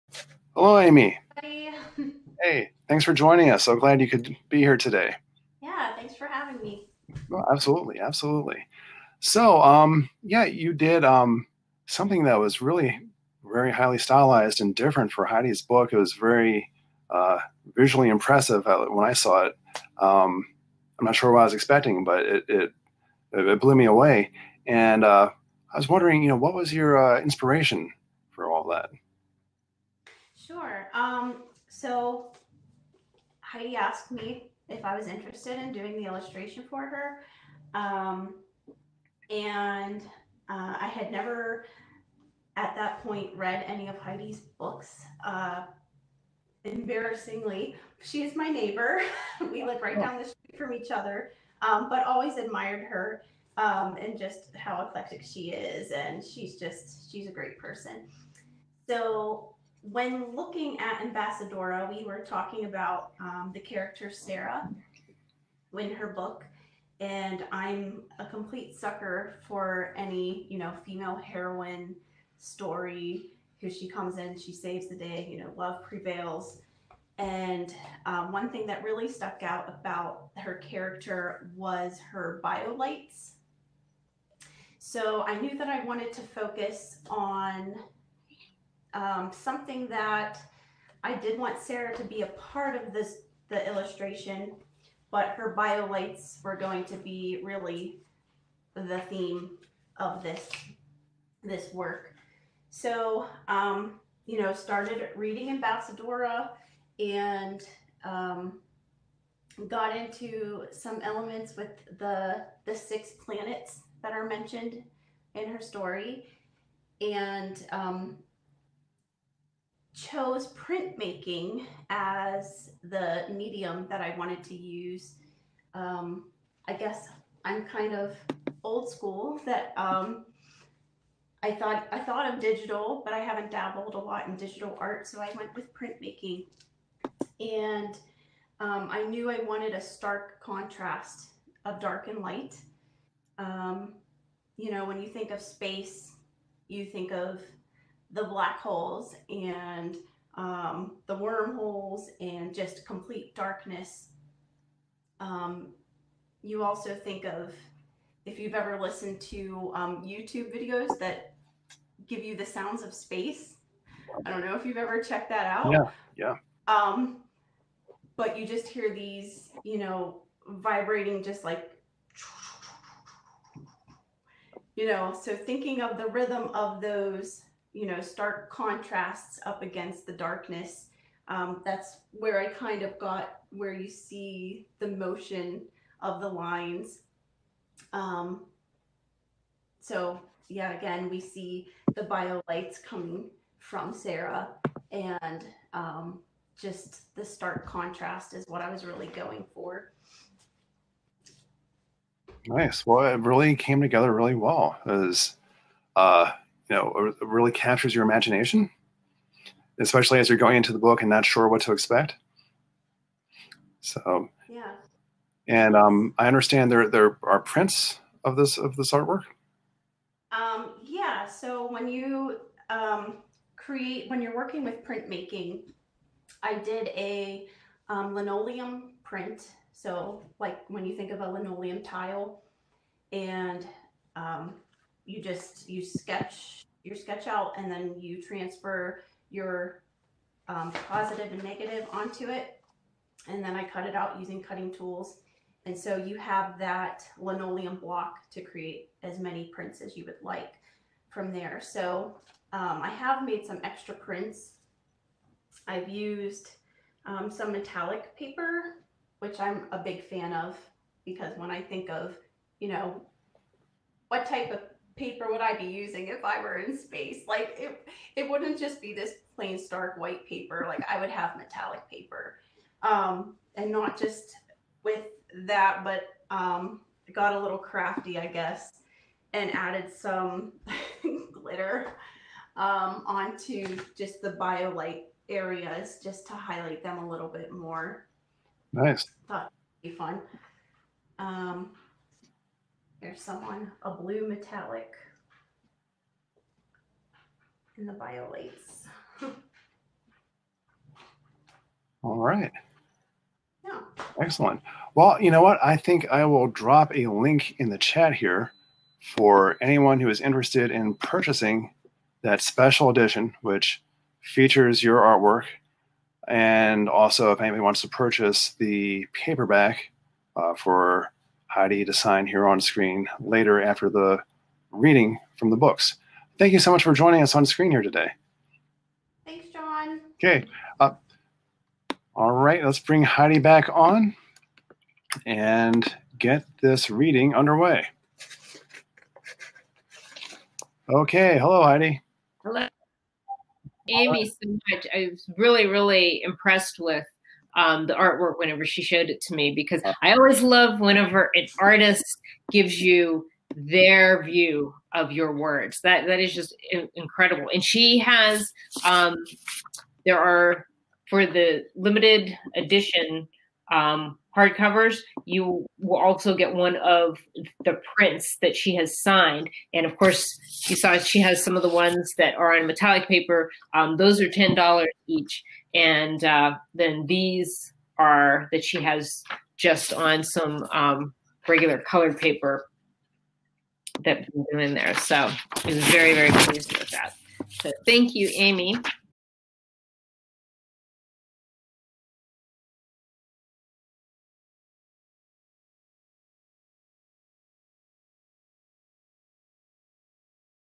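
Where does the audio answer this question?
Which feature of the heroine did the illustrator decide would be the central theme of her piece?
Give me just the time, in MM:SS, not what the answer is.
01:22.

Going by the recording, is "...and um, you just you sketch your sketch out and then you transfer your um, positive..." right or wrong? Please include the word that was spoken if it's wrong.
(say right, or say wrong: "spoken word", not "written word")
right.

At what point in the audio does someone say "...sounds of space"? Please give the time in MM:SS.
02:42.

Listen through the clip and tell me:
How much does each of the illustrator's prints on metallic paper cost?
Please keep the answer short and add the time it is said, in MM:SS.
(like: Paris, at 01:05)
$10, at 06:14.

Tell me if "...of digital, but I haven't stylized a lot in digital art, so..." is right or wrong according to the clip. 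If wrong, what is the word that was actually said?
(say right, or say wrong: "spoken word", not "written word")
wrong: "dabbled", not "stylized".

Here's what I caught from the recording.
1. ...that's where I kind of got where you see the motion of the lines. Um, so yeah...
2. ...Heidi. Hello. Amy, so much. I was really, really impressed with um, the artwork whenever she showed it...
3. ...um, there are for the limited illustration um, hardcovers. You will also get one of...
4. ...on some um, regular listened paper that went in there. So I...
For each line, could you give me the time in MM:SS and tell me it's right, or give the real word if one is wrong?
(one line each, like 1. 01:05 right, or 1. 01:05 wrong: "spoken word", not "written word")
1. 03:01 right
2. 05:41 right
3. 05:58 wrong: "edition", not "illustration"
4. 06:19 wrong: "colored", not "listened".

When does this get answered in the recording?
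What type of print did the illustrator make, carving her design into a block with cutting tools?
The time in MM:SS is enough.
03:48.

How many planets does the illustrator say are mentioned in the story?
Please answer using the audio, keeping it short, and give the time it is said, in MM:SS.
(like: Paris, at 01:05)
6, at 01:52.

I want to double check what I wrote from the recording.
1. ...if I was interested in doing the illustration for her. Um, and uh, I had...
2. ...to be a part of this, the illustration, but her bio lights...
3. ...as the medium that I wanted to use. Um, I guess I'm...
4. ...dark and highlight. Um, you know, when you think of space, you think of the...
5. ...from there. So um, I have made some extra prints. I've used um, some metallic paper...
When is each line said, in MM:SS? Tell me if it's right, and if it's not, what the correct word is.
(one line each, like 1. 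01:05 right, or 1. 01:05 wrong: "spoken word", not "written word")
1. 00:34 right
2. 01:31 right
3. 02:01 right
4. 02:21 wrong: "light", not "highlight"
5. 04:11 right.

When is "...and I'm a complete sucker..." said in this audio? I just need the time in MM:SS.
01:06.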